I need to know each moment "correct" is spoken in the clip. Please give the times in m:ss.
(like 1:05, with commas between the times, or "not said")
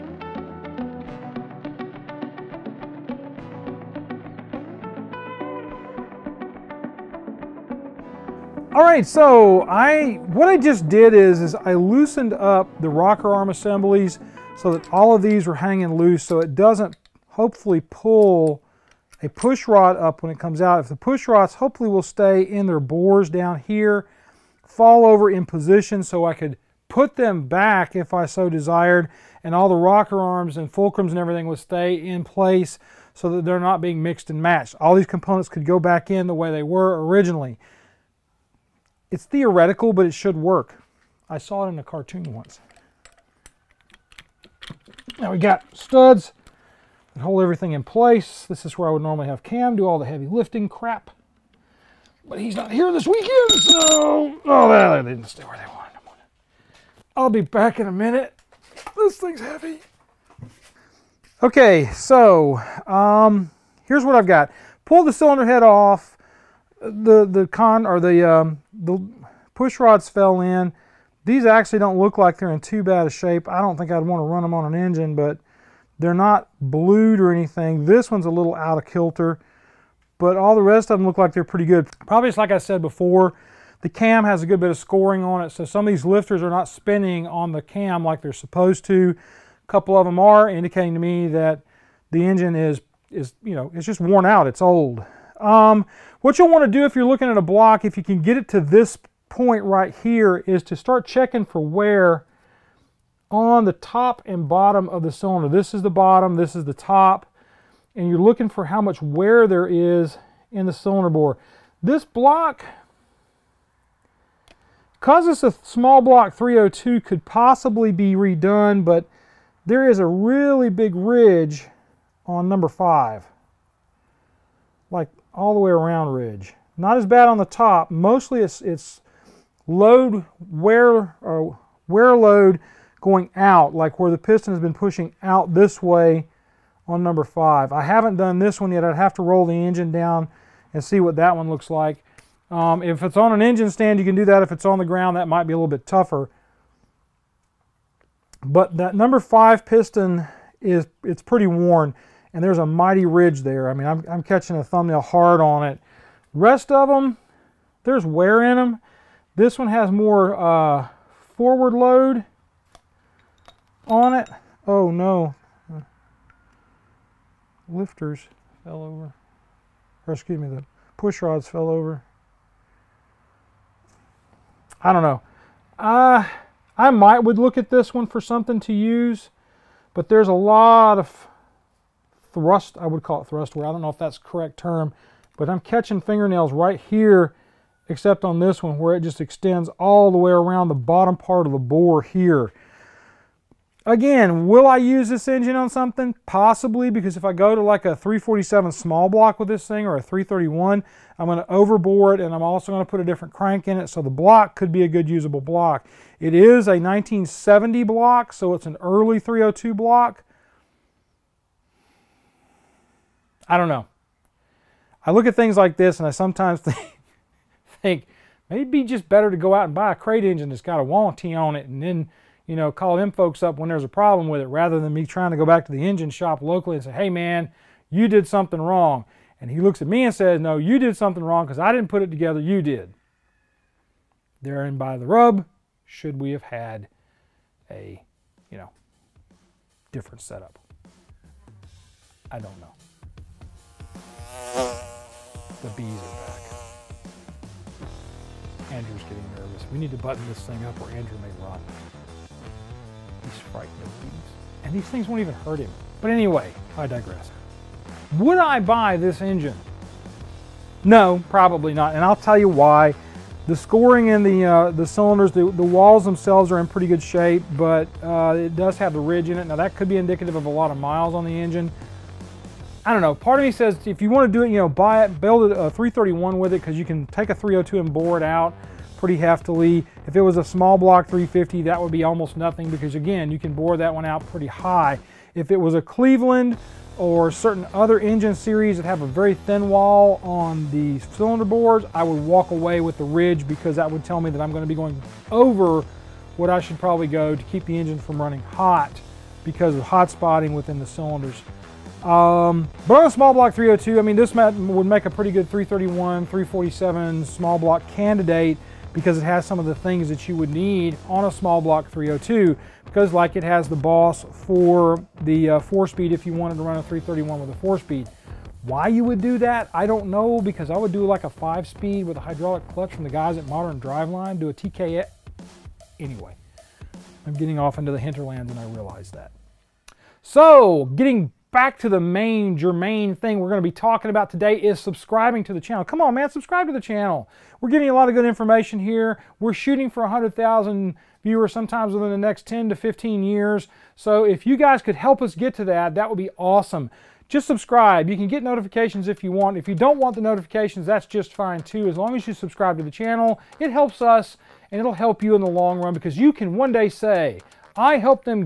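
3:04.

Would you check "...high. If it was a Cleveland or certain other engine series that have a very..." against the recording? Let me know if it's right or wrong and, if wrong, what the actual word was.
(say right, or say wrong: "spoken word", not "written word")
right.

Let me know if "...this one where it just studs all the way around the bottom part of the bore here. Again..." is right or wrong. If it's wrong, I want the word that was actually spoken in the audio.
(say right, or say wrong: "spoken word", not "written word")
wrong: "extends", not "studs".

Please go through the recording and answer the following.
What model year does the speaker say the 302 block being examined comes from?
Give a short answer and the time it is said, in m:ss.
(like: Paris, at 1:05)
1970, at 3:26.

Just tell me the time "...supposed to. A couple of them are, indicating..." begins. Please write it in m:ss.
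1:28.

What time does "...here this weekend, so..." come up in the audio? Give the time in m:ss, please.
0:52.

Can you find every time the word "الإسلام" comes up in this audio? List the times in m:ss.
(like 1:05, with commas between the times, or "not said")
not said.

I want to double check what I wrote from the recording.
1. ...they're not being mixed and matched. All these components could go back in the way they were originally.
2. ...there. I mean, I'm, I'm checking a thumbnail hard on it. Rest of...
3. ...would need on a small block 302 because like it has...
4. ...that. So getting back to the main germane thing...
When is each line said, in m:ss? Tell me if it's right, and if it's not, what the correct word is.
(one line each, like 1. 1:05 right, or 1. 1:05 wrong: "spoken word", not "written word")
1. 0:33 right
2. 2:33 wrong: "catching", not "checking"
3. 5:10 right
4. 5:29 right.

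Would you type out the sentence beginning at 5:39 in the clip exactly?
We're shooting for 100,000 viewers sometimes within the next 10 to 15 years.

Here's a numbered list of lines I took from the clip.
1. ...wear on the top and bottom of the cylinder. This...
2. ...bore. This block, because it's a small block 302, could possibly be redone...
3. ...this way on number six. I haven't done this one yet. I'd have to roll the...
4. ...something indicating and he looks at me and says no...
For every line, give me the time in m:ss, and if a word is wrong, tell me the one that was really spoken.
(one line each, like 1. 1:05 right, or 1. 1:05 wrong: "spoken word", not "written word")
1. 1:41 right
2. 1:51 right
3. 2:15 wrong: "five", not "six"
4. 3:48 wrong: "wrong", not "indicating".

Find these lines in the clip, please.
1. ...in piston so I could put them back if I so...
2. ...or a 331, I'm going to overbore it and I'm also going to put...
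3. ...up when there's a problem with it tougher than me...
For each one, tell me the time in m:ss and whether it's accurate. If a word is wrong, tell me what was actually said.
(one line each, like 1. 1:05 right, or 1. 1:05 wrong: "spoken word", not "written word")
1. 0:25 wrong: "position", not "piston"
2. 3:19 right
3. 3:43 wrong: "rather", not "tougher".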